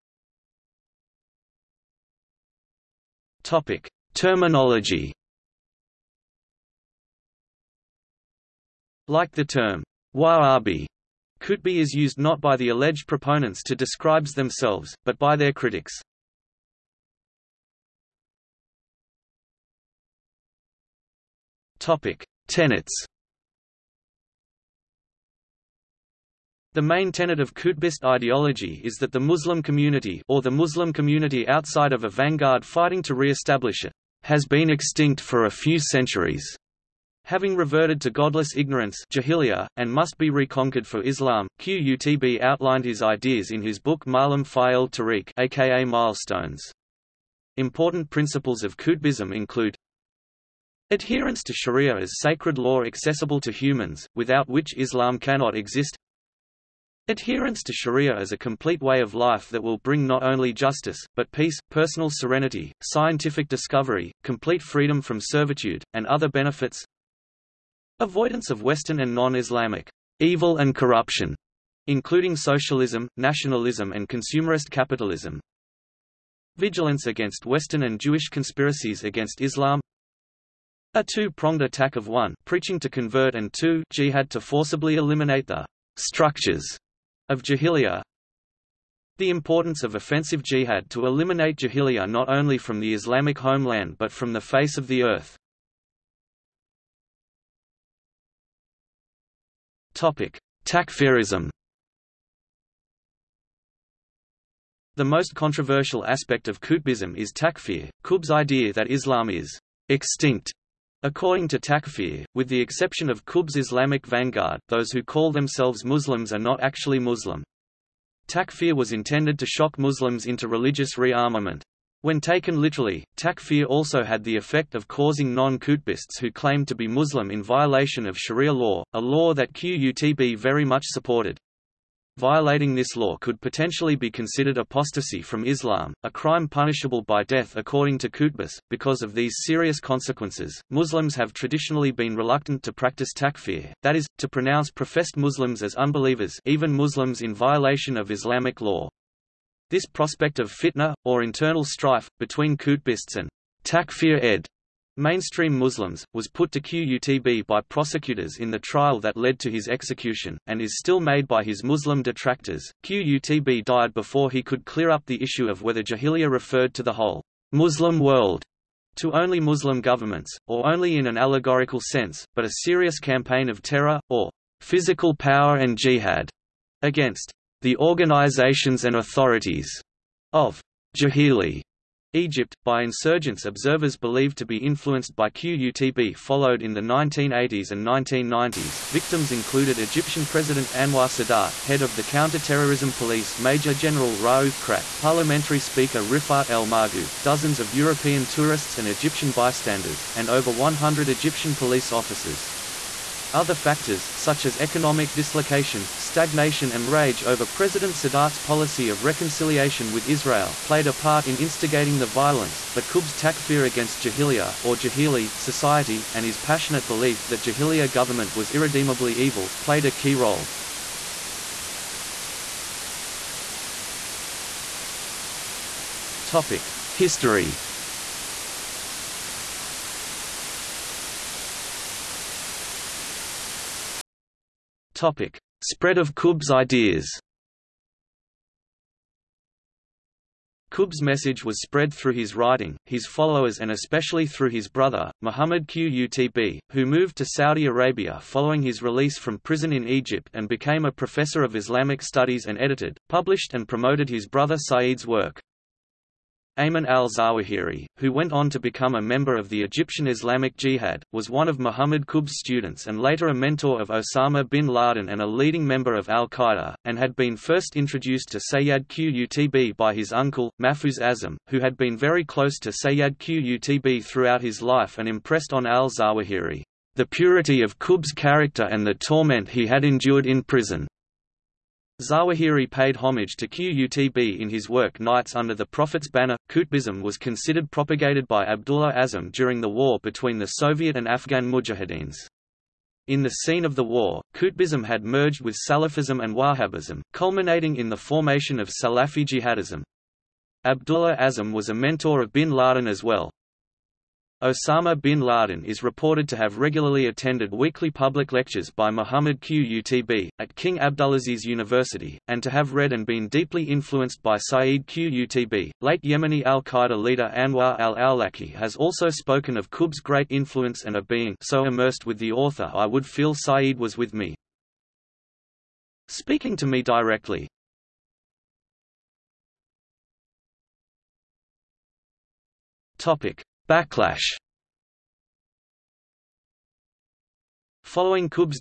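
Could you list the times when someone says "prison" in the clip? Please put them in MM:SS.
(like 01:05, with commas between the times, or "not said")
04:09, 04:40.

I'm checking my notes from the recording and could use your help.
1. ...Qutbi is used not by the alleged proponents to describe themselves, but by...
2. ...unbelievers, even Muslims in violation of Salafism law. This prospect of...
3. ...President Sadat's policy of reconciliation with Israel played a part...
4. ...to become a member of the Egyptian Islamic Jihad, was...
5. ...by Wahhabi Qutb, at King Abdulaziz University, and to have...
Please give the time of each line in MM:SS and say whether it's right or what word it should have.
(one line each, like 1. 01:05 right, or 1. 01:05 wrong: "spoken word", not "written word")
1. 00:11 right
2. 02:25 wrong: "Islamic", not "Salafism"
3. 03:27 right
4. 04:18 right
5. 05:08 wrong: "Muhammad", not "Wahhabi".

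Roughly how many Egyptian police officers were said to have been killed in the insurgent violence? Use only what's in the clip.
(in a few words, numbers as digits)
over 100.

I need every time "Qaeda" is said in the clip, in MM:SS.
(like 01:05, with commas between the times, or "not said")
04:26, 05:16.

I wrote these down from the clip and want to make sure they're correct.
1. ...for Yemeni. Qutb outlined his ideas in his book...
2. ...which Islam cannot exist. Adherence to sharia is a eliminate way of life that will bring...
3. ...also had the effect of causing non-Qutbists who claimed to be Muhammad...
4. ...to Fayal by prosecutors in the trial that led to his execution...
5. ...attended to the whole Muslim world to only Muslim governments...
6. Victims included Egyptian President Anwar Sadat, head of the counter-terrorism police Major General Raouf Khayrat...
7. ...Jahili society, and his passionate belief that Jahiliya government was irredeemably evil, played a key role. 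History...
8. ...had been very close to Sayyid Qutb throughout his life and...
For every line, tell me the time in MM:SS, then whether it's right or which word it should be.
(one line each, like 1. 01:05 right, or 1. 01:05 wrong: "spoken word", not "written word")
1. 00:40 wrong: "Islam", not "Yemeni"
2. 00:54 wrong: "complete", not "eliminate"
3. 02:03 wrong: "Muslim", not "Muhammad"
4. 02:36 wrong: "QUTB", not "Fayal"
5. 02:46 wrong: "referred", not "attended"
6. 03:08 right
7. 03:34 right
8. 04:31 right.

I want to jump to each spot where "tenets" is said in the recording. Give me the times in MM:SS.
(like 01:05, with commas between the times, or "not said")
00:22, 00:27.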